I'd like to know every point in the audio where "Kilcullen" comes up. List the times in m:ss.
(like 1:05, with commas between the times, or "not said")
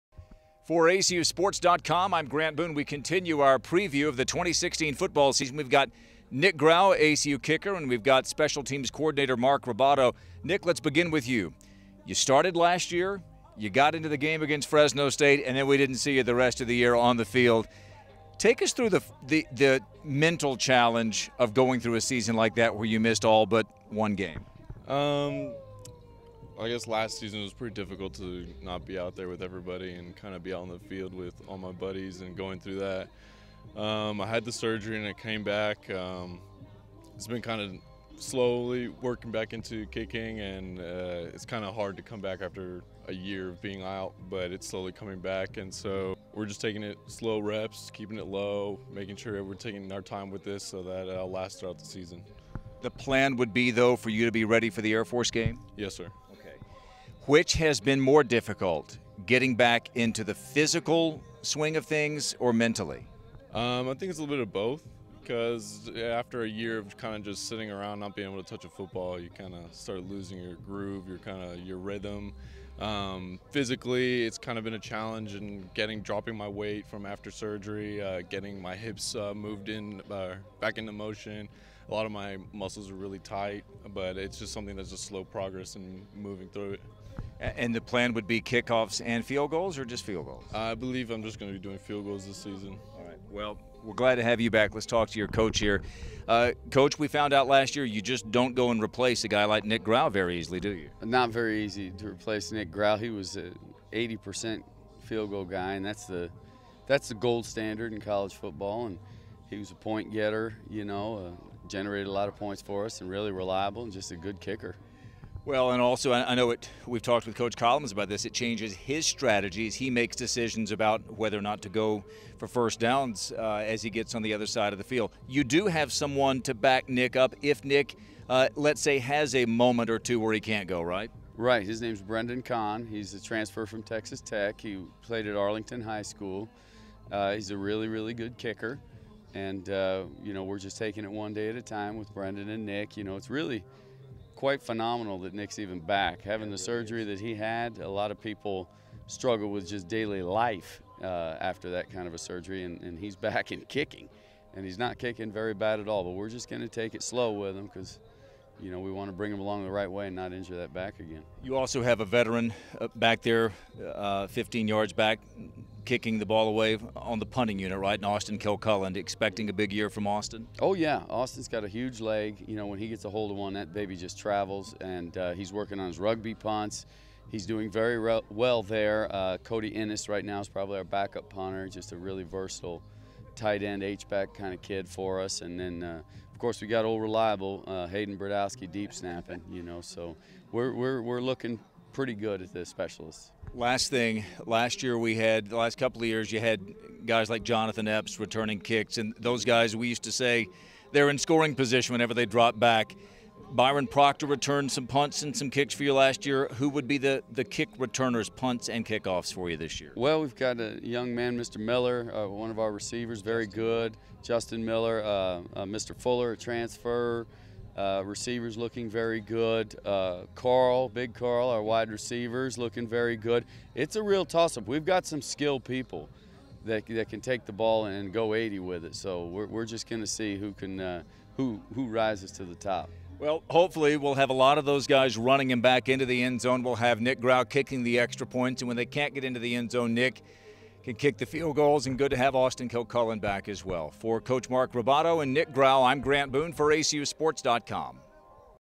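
2:48, 4:02.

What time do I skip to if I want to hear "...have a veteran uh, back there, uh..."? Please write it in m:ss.
2:41.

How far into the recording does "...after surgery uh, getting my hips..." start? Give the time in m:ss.
1:17.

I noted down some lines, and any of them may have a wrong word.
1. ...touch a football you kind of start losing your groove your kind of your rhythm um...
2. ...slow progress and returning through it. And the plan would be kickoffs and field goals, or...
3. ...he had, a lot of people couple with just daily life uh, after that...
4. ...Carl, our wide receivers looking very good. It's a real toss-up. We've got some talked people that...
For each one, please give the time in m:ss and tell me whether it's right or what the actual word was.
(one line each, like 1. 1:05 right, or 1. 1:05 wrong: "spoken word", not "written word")
1. 1:08 right
2. 1:24 wrong: "moving", not "returning"
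3. 2:27 wrong: "struggle", not "couple"
4. 3:41 wrong: "skilled", not "talked".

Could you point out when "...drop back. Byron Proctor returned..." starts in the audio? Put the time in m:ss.
3:22.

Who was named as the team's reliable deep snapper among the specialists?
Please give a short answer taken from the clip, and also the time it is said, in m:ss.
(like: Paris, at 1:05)
Hayden Bradowski, at 3:07.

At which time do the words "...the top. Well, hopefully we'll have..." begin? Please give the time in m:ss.
3:52.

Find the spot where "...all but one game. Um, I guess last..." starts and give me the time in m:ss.
0:23.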